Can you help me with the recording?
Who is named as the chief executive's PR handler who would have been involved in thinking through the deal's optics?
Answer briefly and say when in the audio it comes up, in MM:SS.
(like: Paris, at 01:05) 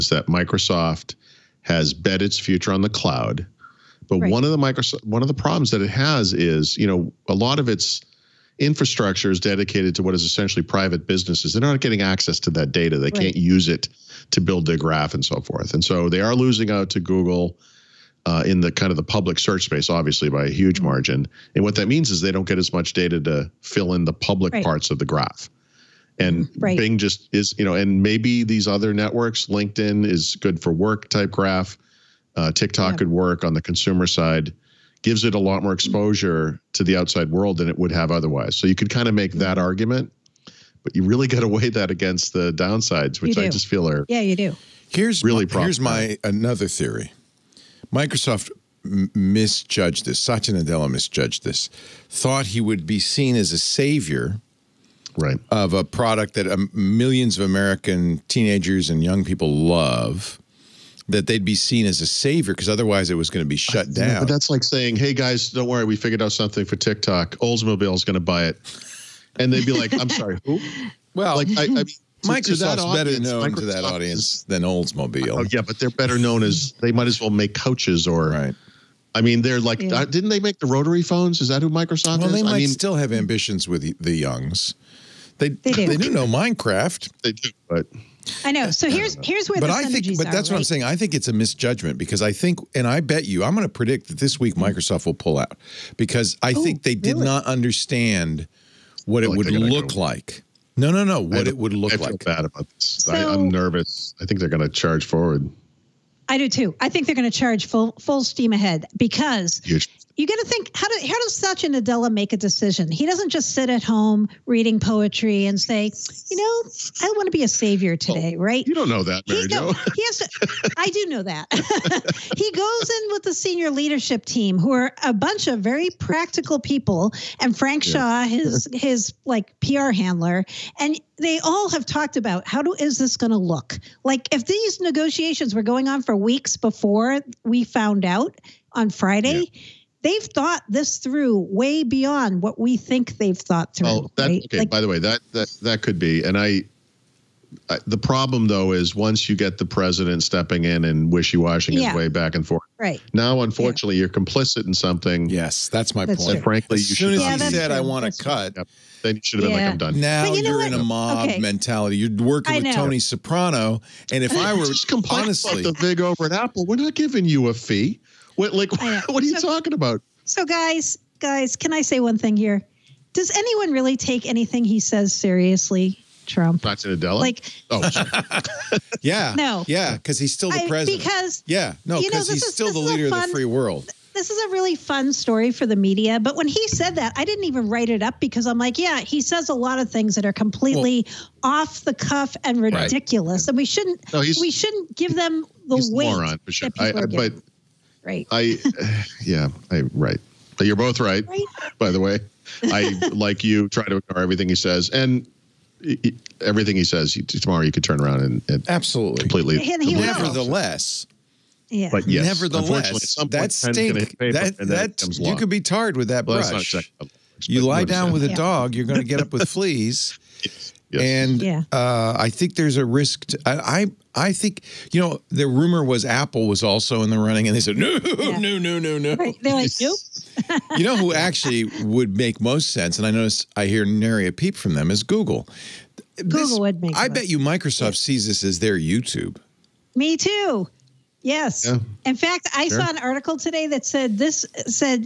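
Frank Shaw, at 02:07.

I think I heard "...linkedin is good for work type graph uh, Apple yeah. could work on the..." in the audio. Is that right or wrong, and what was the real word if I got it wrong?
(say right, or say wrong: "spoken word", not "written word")
wrong: "TikTok", not "Apple".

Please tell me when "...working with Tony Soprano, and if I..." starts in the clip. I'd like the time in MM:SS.
02:42.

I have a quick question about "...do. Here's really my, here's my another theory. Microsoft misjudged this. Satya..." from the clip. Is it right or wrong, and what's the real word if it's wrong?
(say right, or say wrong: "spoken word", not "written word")
right.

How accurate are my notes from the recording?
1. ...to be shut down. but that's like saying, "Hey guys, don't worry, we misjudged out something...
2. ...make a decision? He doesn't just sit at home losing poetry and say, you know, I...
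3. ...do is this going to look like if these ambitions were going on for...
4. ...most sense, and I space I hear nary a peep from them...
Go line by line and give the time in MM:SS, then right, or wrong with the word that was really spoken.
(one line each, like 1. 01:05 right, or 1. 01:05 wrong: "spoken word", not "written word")
1. 01:03 wrong: "figured", not "misjudged"
2. 01:52 wrong: "reading", not "losing"
3. 02:12 wrong: "negotiations", not "ambitions"
4. 03:52 wrong: "notice", not "space".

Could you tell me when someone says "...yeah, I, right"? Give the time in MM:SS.
03:19.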